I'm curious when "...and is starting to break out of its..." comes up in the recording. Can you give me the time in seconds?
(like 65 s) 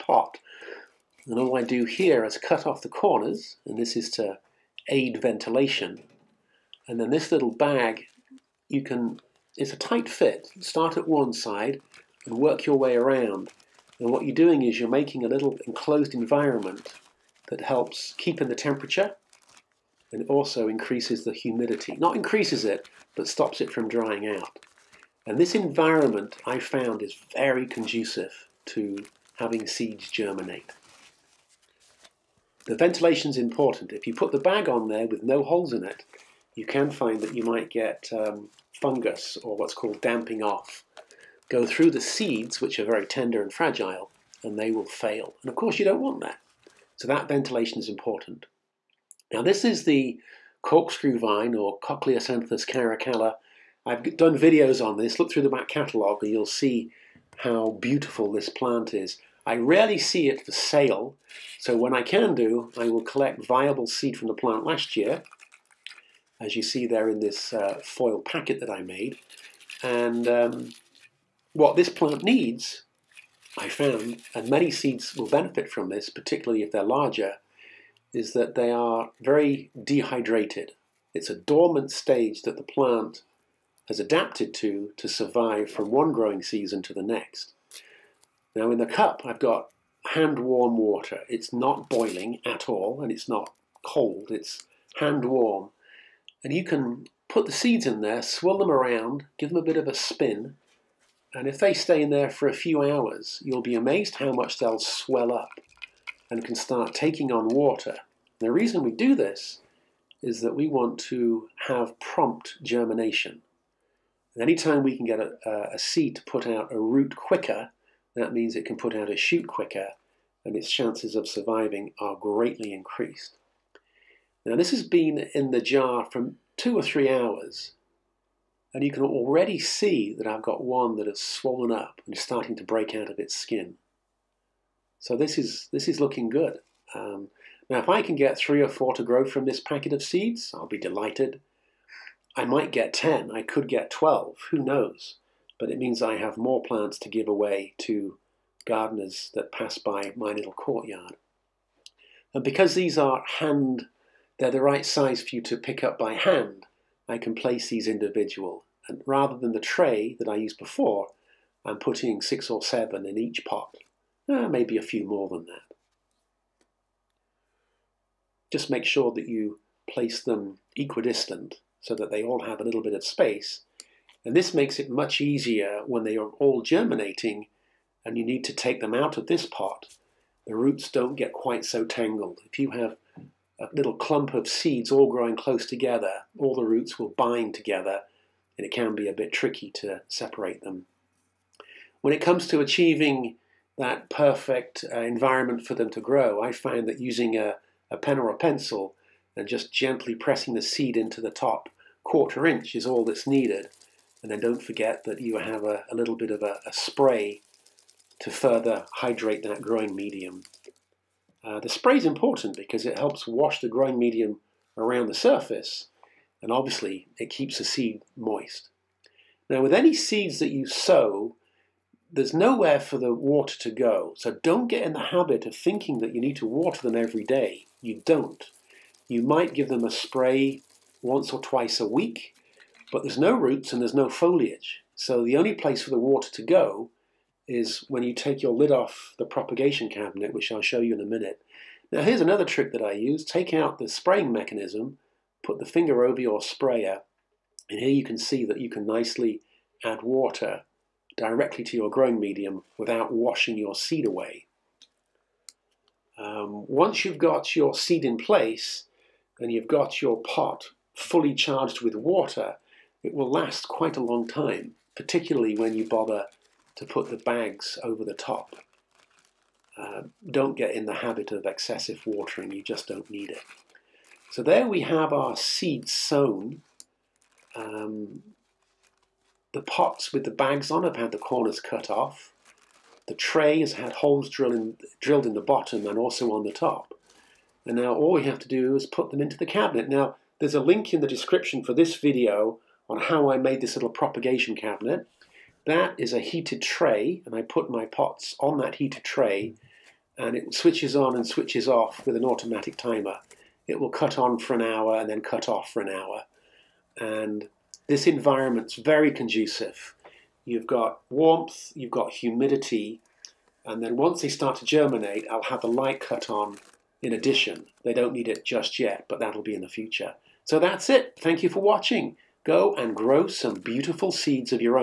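132 s.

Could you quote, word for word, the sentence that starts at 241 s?
Now here's another trick that I use.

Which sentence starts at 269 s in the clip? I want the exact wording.
Uh, don't get in the habit of excessive watering, you just don't need it.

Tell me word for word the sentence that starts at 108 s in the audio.
The reason we do this is that we want to have prompt germination.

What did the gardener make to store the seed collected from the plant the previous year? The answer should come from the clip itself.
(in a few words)
foil packet.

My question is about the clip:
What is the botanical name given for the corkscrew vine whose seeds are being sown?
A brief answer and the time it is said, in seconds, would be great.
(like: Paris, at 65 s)
Cochliasanthus caracalla, at 51 s.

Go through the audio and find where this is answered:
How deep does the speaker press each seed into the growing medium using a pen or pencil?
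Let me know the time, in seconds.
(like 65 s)
201 s.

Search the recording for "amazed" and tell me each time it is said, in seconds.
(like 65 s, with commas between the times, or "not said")
103 s.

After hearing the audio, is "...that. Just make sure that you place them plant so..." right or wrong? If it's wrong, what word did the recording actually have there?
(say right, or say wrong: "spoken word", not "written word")
wrong: "equidistant", not "plant".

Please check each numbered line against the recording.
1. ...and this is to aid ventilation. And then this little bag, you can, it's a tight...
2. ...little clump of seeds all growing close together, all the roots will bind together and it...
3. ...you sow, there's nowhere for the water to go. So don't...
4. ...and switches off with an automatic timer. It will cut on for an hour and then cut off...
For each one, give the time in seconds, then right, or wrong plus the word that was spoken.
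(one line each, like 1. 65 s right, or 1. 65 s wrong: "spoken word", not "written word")
1. 3 s right
2. 183 s right
3. 220 s right
4. 301 s right.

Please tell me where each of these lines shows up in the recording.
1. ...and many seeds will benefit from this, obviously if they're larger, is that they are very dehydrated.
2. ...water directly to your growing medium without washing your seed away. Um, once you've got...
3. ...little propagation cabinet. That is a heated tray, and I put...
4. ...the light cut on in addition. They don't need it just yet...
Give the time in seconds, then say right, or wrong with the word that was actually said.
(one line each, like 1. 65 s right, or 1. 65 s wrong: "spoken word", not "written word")
1. 74 s wrong: "particularly", not "obviously"
2. 250 s right
3. 293 s right
4. 315 s right.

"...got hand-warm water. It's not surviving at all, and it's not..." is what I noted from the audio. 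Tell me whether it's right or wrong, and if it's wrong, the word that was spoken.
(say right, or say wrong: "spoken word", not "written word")
wrong: "boiling", not "surviving".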